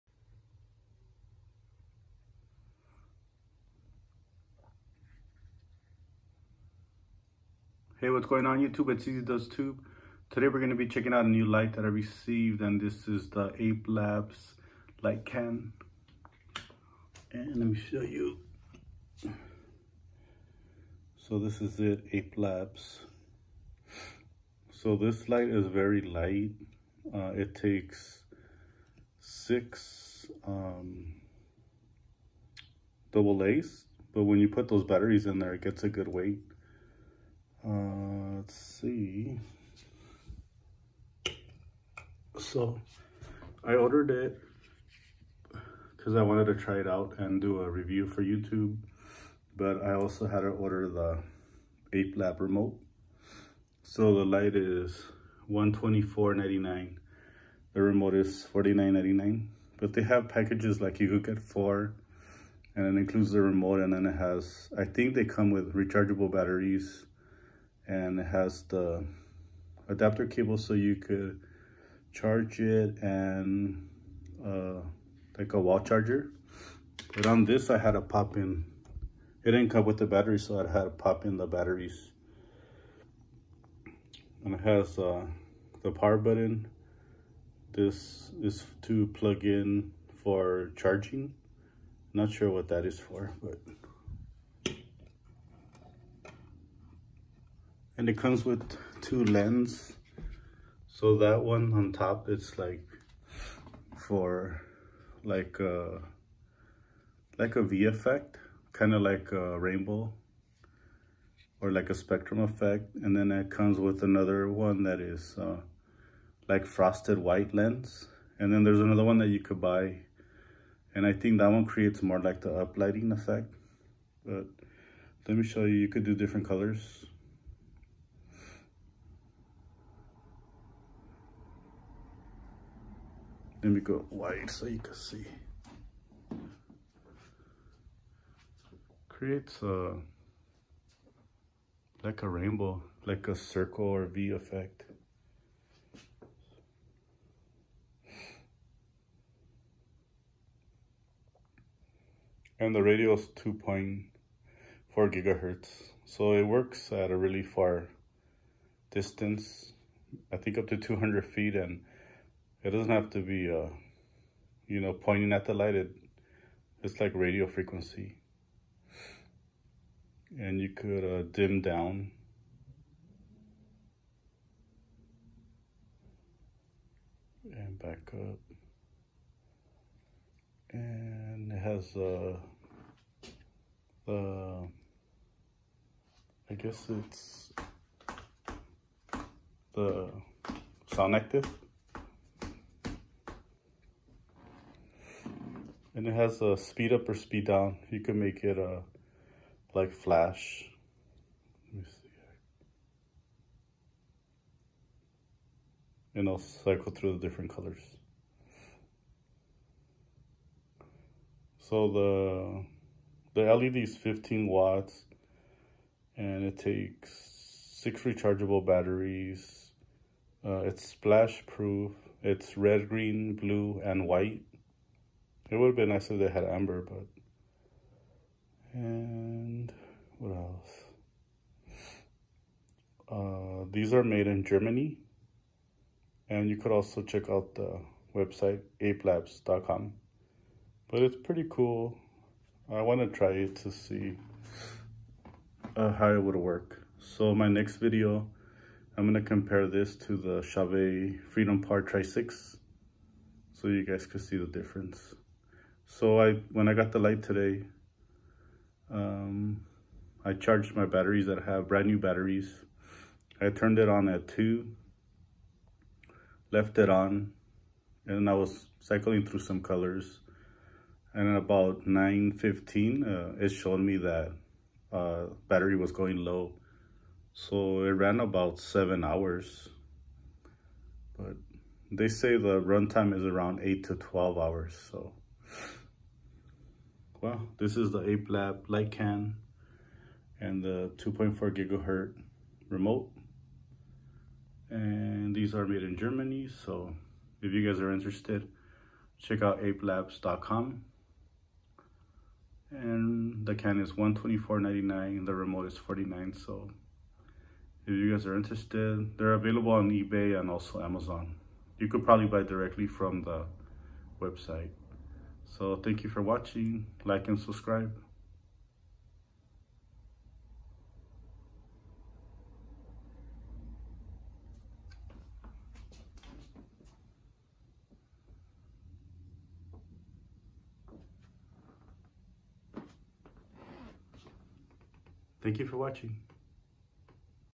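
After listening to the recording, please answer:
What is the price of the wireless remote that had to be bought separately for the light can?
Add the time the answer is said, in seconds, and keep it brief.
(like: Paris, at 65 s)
$49.99, at 58 s.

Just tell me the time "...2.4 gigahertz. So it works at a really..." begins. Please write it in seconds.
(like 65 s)
153 s.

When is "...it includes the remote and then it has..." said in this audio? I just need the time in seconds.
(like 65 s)
62 s.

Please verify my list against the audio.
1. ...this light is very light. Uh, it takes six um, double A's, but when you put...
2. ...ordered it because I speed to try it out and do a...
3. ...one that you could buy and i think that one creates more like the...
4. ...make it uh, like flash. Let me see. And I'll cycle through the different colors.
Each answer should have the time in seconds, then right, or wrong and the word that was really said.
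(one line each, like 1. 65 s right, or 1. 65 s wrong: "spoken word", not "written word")
1. 24 s right
2. 43 s wrong: "wanted", not "speed"
3. 119 s right
4. 198 s right.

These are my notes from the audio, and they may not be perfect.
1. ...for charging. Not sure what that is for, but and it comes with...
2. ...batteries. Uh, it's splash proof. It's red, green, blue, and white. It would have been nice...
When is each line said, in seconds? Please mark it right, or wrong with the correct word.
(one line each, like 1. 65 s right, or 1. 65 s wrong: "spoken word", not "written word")
1. 90 s right
2. 218 s right.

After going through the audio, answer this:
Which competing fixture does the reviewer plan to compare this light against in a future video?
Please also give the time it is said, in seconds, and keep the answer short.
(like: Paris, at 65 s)
Chauvet Freedom Par Tri-6, at 250 s.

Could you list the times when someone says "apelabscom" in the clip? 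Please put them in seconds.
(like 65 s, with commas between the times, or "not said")
238 s, 299 s.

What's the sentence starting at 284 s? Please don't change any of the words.
So well, this is the Ape Lab light can and the 2.4 gigahertz remote.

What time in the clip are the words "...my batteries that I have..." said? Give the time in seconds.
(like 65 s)
260 s.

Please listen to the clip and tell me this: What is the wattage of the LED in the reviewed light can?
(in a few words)
15 watts.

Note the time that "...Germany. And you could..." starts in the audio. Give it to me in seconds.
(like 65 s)
234 s.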